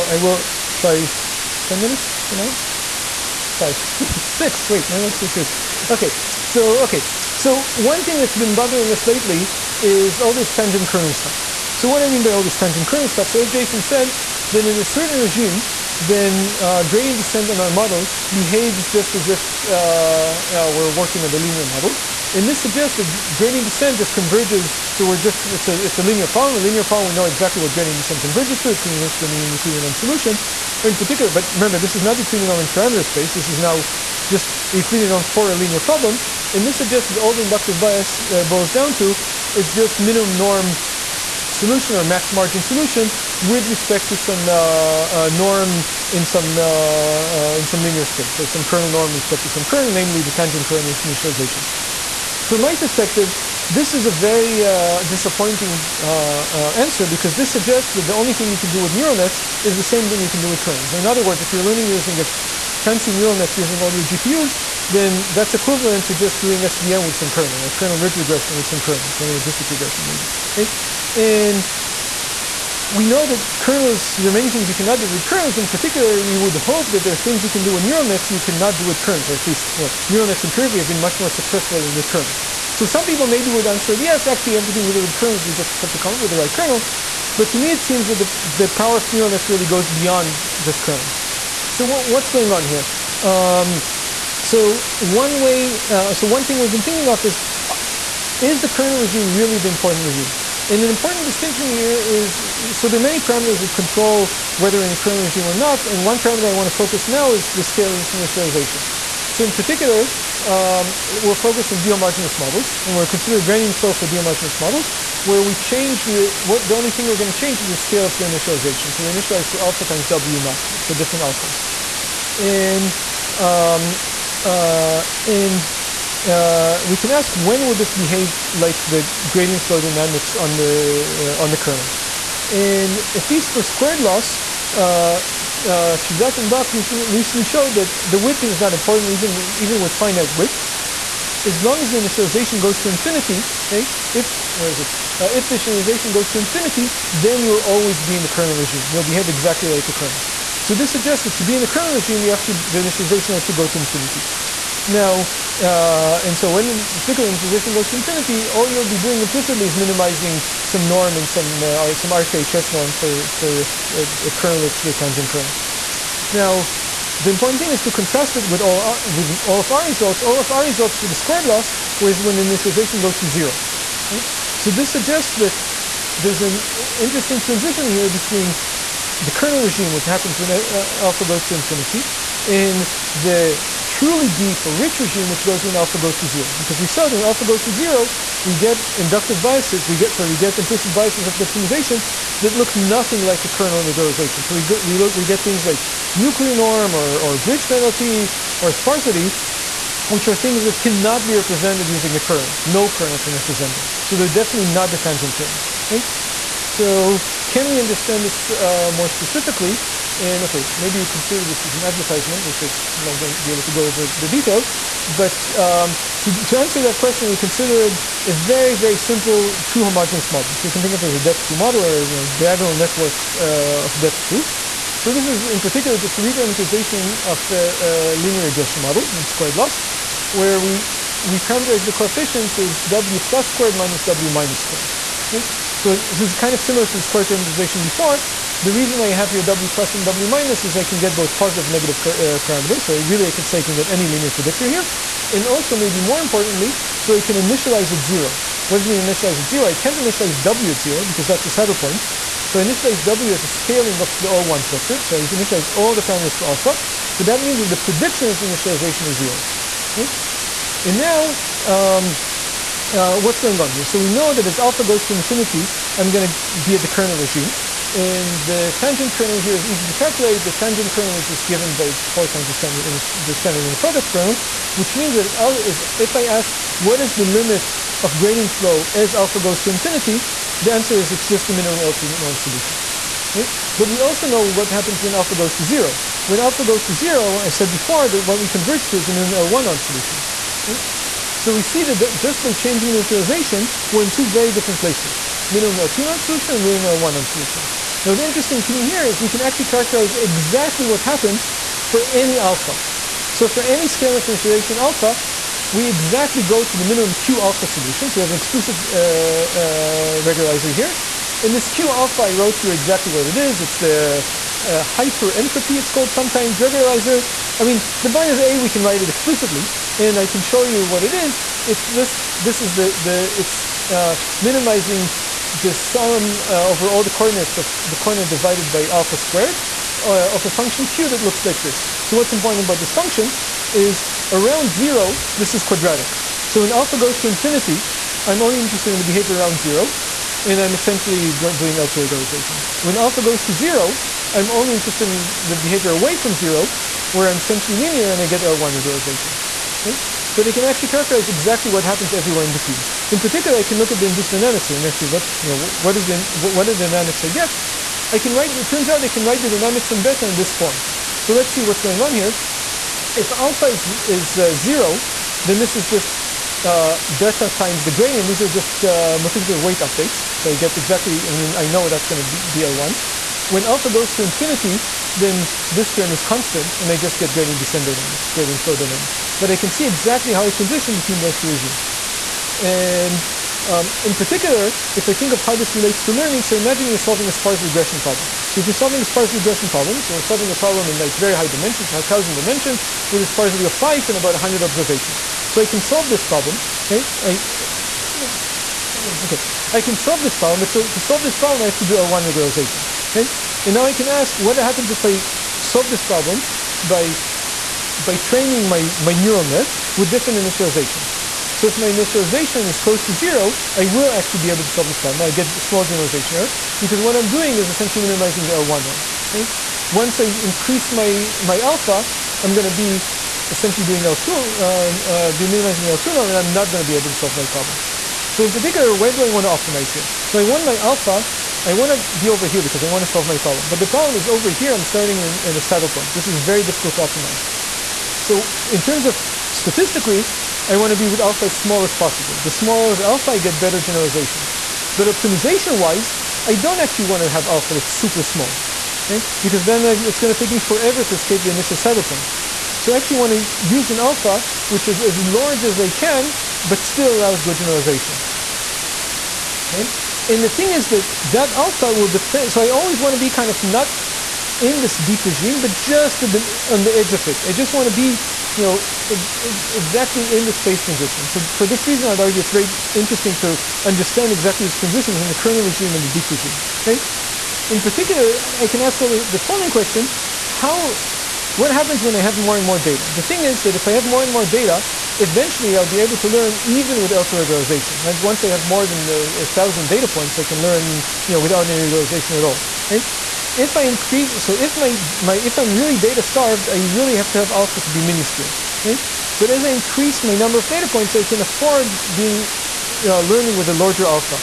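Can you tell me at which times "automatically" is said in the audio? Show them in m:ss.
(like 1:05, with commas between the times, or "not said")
not said.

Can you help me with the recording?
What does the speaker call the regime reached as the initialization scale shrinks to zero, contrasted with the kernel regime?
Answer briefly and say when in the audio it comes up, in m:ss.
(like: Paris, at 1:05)
truly deep or rich regime, at 3:03.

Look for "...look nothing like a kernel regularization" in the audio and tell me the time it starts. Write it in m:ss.
3:12.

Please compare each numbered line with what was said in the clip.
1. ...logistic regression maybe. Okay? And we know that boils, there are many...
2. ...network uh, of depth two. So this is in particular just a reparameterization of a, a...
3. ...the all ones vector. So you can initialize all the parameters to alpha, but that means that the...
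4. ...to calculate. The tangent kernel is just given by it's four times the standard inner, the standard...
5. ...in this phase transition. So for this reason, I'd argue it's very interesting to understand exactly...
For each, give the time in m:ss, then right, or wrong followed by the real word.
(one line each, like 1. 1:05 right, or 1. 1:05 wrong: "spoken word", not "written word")
1. 1:09 wrong: "kernels", not "boils"
2. 3:42 right
3. 4:14 right
4. 4:29 right
5. 7:50 right.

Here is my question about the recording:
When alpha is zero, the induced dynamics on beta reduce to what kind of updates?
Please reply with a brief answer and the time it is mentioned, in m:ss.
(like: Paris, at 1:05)
multiplicative weight updates, at 6:09.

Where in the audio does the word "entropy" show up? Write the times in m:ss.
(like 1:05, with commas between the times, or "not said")
5:15.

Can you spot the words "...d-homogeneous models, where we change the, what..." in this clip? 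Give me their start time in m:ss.
1:54.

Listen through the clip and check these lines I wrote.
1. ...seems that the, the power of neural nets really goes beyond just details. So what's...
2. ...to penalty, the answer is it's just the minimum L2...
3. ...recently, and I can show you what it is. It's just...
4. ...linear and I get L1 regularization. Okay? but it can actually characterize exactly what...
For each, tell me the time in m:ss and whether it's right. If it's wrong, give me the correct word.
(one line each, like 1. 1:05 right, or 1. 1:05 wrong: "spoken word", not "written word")
1. 1:27 wrong: "kernels", not "details"
2. 4:39 wrong: "infinity", not "penalty"
3. 5:19 wrong: "explicitly", not "recently"
4. 5:47 right.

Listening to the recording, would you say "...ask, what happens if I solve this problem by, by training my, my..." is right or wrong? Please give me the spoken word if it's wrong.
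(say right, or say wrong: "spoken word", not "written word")
right.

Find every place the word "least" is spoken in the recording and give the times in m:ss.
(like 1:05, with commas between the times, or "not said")
1:19, 2:13.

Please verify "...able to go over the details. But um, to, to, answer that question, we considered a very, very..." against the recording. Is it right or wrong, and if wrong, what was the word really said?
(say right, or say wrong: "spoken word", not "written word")
right.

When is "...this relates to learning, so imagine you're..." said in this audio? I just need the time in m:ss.
6:25.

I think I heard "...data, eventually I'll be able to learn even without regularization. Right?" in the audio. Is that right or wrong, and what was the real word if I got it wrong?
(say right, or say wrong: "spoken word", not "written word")
right.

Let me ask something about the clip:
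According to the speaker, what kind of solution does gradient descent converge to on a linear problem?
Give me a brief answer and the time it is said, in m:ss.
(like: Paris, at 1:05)
minimum Euclidean norm solution, at 0:29.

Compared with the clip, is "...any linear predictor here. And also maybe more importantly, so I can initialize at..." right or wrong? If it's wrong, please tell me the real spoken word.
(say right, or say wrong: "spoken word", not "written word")
right.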